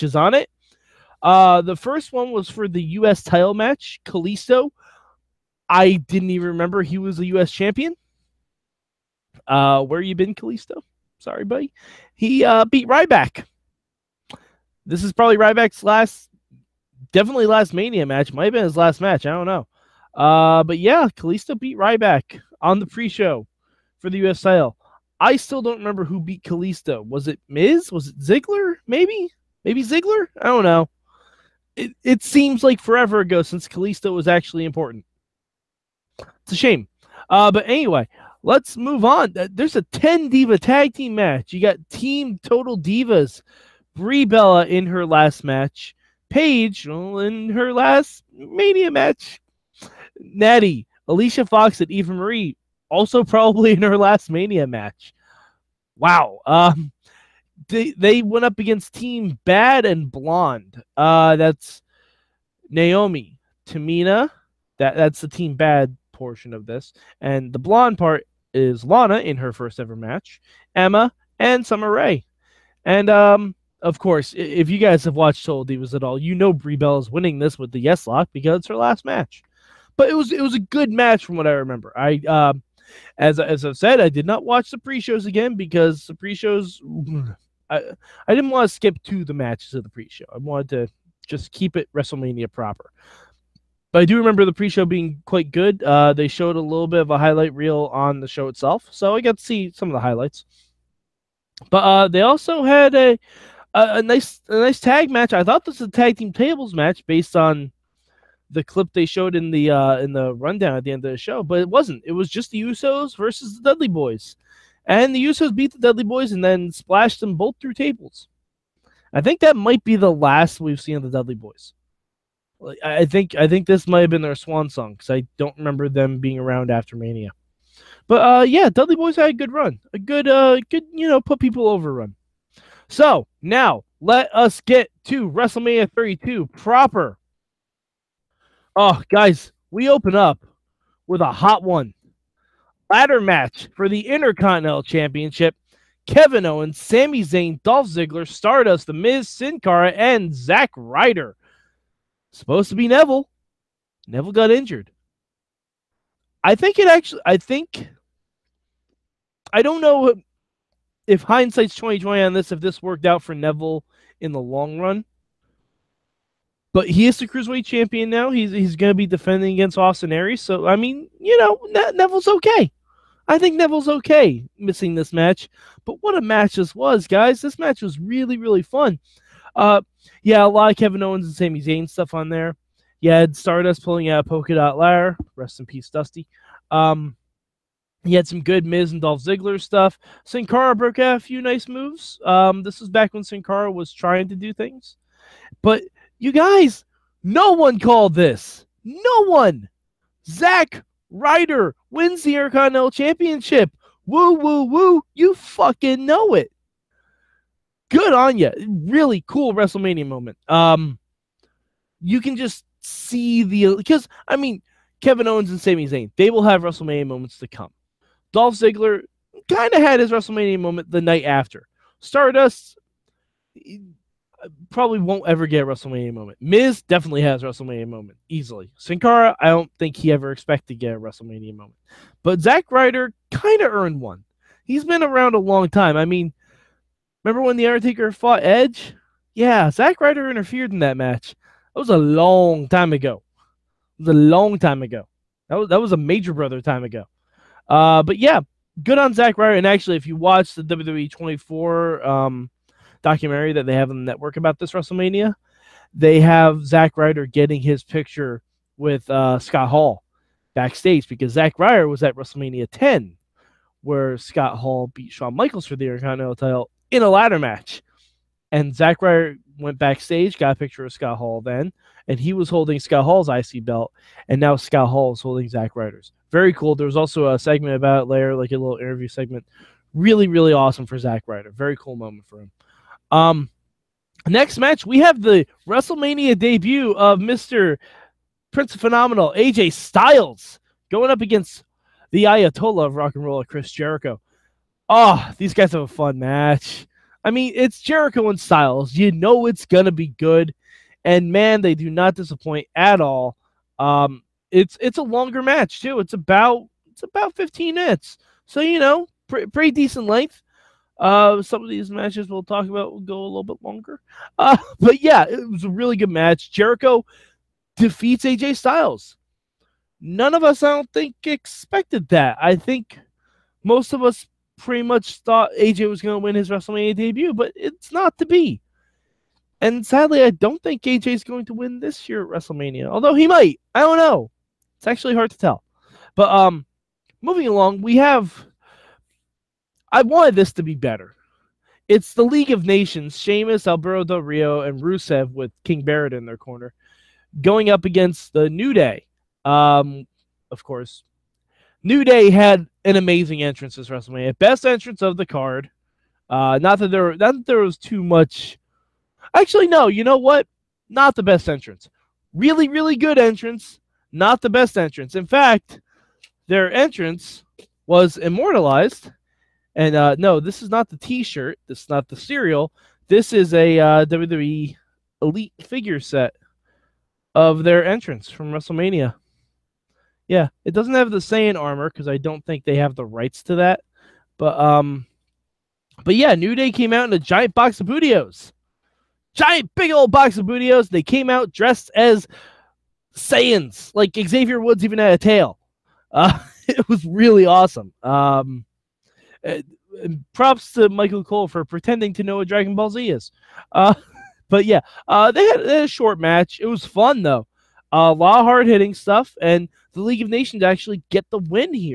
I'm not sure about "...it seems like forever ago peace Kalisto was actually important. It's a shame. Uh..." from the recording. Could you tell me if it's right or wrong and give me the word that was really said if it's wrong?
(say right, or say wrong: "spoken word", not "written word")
wrong: "since", not "peace".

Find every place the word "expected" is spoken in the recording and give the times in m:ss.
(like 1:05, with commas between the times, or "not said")
3:50, 5:21.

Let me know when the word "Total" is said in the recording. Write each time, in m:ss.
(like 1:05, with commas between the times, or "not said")
0:42, 1:15.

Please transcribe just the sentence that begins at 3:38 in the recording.
Dolph Ziggler kind of had his WrestleMania moment the night after.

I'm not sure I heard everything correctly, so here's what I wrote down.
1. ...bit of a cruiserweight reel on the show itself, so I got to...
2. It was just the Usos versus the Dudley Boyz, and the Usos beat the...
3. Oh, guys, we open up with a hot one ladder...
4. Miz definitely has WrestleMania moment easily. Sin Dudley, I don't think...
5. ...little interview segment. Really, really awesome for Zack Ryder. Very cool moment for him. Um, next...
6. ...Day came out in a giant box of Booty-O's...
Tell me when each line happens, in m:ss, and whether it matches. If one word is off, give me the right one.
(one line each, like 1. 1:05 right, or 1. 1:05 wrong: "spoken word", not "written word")
1. 1:36 wrong: "highlight", not "cruiserweight"
2. 1:52 right
3. 2:18 right
4. 3:46 wrong: "Cara", not "Dudley"
5. 4:38 right
6. 6:26 right.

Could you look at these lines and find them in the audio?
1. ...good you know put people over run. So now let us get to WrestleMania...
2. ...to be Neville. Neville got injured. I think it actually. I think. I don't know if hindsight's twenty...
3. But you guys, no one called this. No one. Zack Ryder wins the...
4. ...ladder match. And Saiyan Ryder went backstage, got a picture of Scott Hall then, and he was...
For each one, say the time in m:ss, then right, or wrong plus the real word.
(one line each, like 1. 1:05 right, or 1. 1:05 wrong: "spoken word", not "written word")
1. 2:10 right
2. 2:32 right
3. 3:15 right
4. 4:27 wrong: "Zack", not "Saiyan".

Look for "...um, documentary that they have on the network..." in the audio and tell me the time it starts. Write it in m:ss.
4:12.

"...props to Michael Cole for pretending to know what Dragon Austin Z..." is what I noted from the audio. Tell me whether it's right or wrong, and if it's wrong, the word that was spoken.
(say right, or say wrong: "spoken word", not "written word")
wrong: "Ball", not "Austin".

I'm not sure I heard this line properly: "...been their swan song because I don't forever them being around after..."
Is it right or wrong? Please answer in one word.
wrong.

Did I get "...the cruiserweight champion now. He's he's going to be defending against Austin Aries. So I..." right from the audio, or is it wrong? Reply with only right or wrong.
right.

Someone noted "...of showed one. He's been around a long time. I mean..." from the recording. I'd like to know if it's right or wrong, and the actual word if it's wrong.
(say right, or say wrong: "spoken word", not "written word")
wrong: "earned", not "showed".